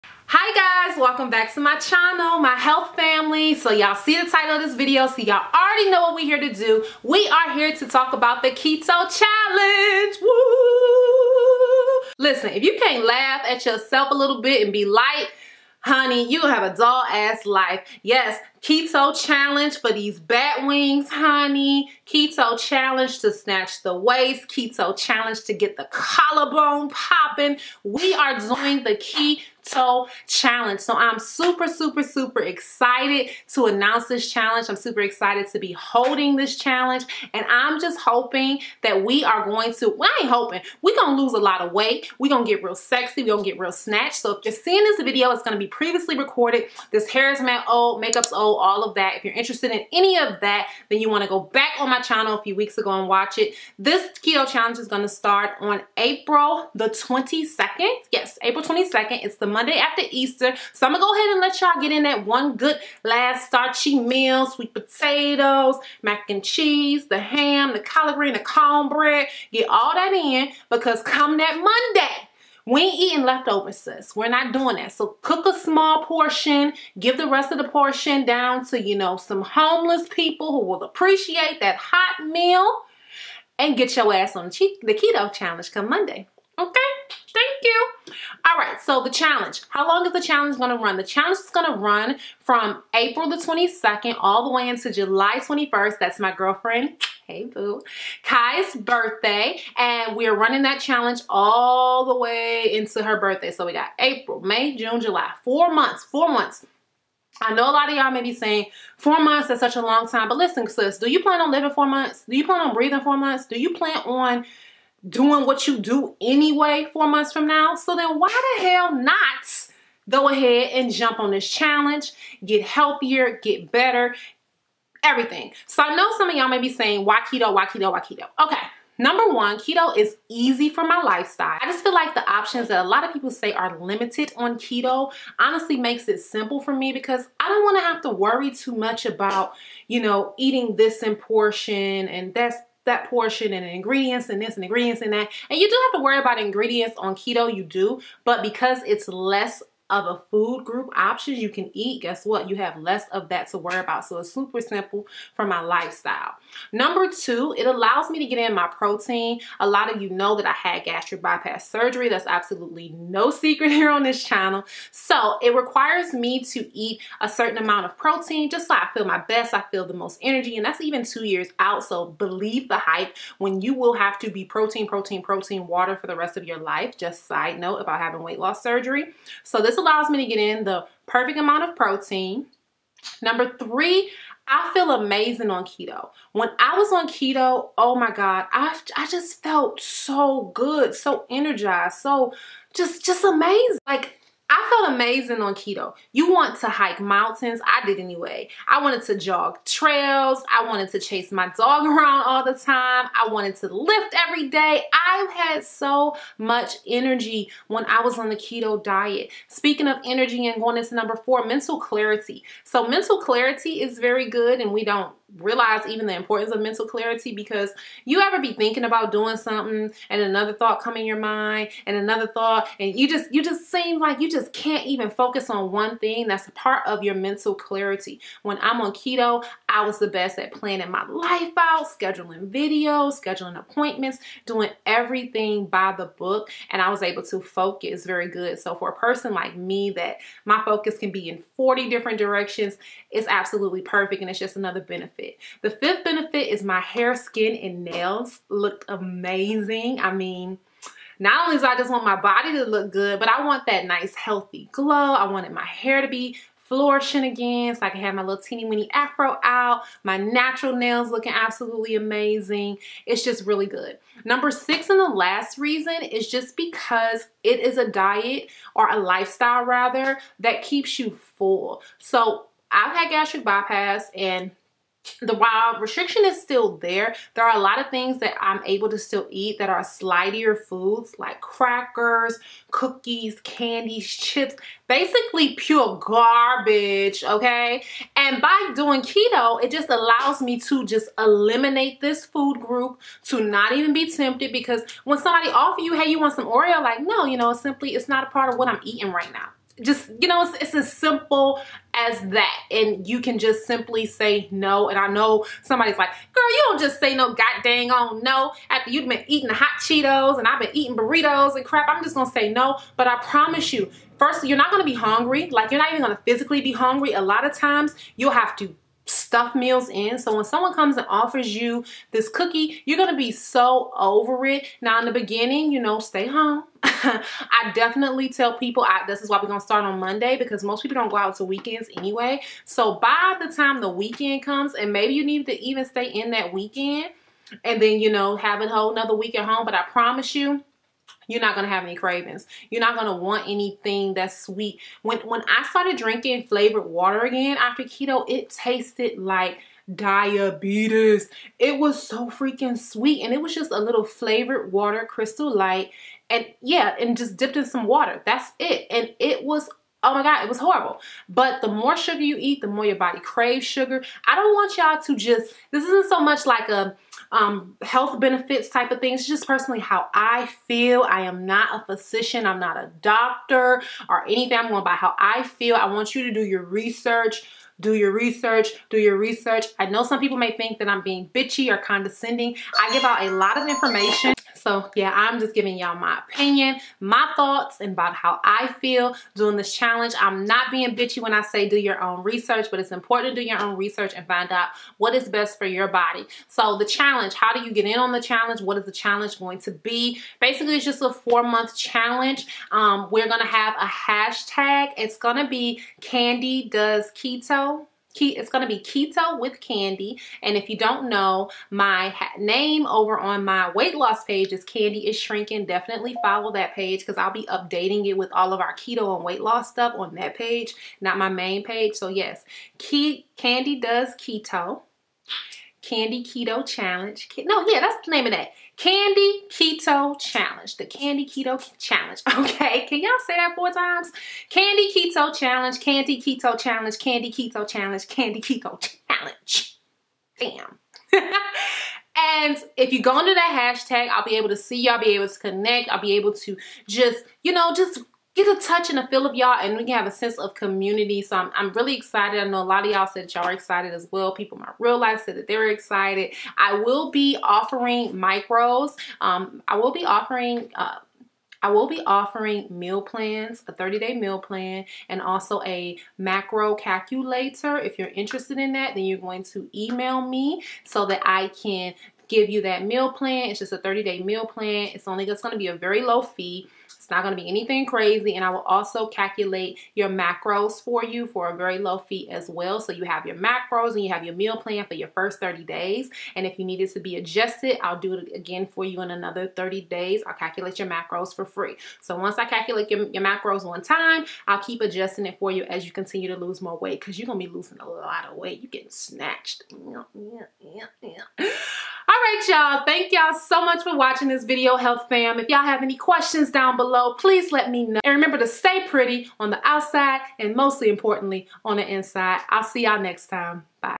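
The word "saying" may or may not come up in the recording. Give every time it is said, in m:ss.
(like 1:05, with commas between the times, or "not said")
1:48, 2:06.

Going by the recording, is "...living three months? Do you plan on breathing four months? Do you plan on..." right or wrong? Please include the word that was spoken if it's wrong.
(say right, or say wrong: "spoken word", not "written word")
wrong: "four", not "three".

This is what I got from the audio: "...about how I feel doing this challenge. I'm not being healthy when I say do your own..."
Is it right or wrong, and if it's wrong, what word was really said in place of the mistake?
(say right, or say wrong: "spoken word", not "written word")
wrong: "bitchy", not "healthy".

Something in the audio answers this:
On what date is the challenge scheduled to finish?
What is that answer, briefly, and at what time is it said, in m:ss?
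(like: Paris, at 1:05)
July 21st, at 1:34.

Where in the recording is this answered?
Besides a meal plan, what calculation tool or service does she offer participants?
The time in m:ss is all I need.
7:46.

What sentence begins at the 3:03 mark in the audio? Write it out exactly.
Number three, I feel amazing on keto.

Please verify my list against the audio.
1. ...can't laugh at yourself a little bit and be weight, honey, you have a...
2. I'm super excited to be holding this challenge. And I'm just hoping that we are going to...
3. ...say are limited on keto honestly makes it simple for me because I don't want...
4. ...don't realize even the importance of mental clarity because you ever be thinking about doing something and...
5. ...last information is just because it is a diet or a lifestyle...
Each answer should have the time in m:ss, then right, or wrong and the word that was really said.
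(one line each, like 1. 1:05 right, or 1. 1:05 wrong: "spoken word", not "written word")
1. 0:12 wrong: "light", not "weight"
2. 0:34 right
3. 2:13 right
4. 3:34 right
5. 4:25 wrong: "reason", not "information".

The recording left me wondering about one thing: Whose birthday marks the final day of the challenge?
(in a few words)
Kai.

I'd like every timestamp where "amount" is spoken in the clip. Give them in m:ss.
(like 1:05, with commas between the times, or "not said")
2:47, 3:01.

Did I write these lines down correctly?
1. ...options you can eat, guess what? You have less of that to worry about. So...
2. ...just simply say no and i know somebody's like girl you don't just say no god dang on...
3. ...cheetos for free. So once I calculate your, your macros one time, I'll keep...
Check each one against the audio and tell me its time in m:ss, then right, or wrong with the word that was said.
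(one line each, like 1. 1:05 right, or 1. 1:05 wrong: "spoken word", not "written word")
1. 2:30 right
2. 5:03 right
3. 8:10 wrong: "macros", not "cheetos".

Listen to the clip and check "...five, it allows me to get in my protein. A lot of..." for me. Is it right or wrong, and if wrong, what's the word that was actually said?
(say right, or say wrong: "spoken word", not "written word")
wrong: "two", not "five".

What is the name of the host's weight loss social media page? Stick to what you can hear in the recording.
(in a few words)
Candi is Shrinking.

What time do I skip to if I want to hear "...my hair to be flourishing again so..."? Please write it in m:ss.
4:15.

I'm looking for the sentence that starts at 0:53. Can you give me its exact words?
This keto challenge is going to start on April the 22nd.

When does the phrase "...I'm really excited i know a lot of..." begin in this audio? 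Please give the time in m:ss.
7:31.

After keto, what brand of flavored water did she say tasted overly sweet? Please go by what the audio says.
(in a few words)
Crystal Light.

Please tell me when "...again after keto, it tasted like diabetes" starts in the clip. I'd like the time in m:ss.
5:47.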